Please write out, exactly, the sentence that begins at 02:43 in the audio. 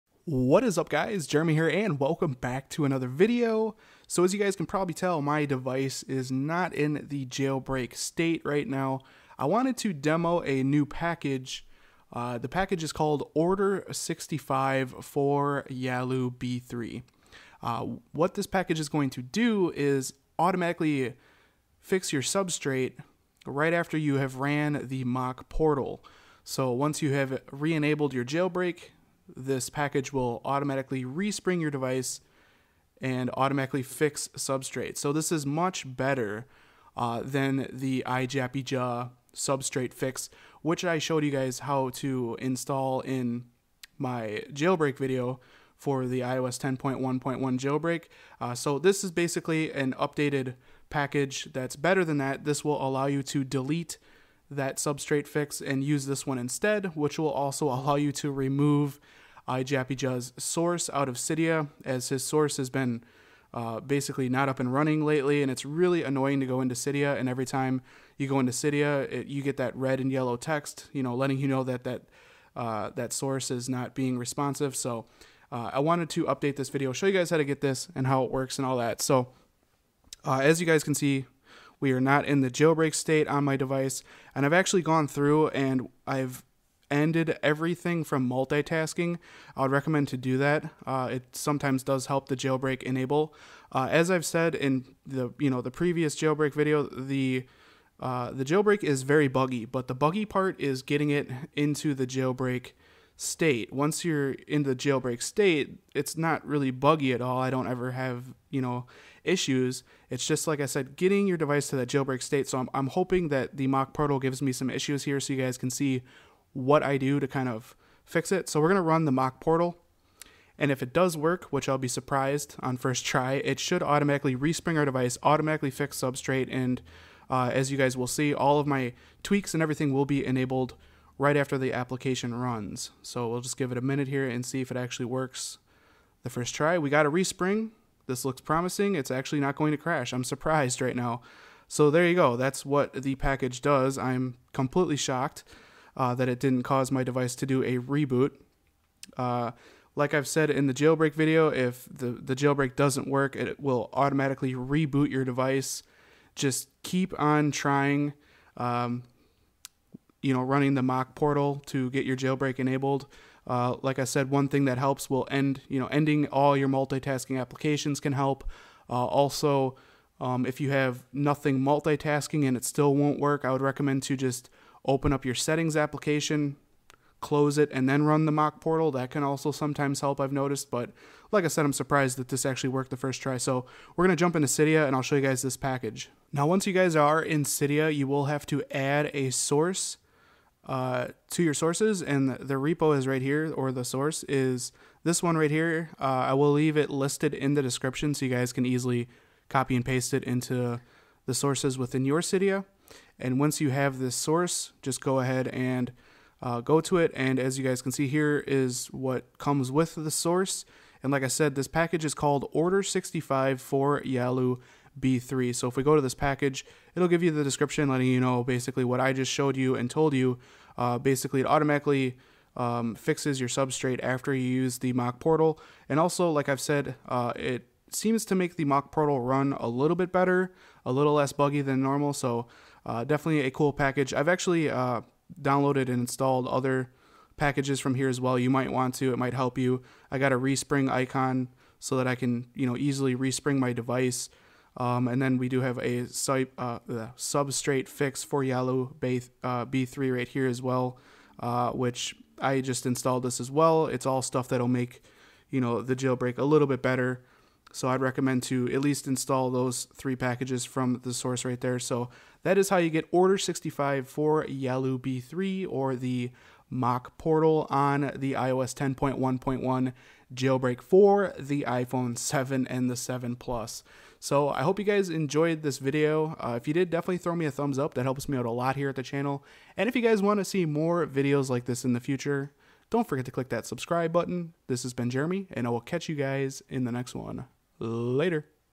Uh, like I said, one thing that helps will end, you know, ending all your multitasking applications can help.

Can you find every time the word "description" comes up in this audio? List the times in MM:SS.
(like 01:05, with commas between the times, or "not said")
03:17, 03:37.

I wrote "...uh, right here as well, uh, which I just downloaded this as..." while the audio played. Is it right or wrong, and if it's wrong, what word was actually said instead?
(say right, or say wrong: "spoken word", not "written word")
wrong: "installed", not "downloaded".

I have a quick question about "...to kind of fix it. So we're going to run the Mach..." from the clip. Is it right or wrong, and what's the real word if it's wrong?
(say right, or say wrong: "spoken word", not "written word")
right.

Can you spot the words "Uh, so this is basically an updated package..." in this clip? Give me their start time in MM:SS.
00:48.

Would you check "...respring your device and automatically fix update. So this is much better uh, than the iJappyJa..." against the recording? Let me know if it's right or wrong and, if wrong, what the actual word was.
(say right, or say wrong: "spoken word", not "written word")
wrong: "substrate", not "update".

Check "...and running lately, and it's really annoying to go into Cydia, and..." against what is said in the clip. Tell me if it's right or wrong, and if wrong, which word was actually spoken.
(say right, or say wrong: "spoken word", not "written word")
right.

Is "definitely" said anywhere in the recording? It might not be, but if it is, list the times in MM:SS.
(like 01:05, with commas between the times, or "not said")
03:53, 04:36.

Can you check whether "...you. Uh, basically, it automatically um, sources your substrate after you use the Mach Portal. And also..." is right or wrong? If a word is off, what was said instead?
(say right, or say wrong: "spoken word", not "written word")
wrong: "fixes", not "sources".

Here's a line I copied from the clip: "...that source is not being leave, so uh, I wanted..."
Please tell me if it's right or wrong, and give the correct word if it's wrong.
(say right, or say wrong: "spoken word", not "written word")
wrong: "responsive", not "leave".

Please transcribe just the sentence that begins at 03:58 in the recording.
You might want to, it might help you.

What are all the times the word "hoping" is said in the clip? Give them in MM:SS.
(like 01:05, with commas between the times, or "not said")
01:52.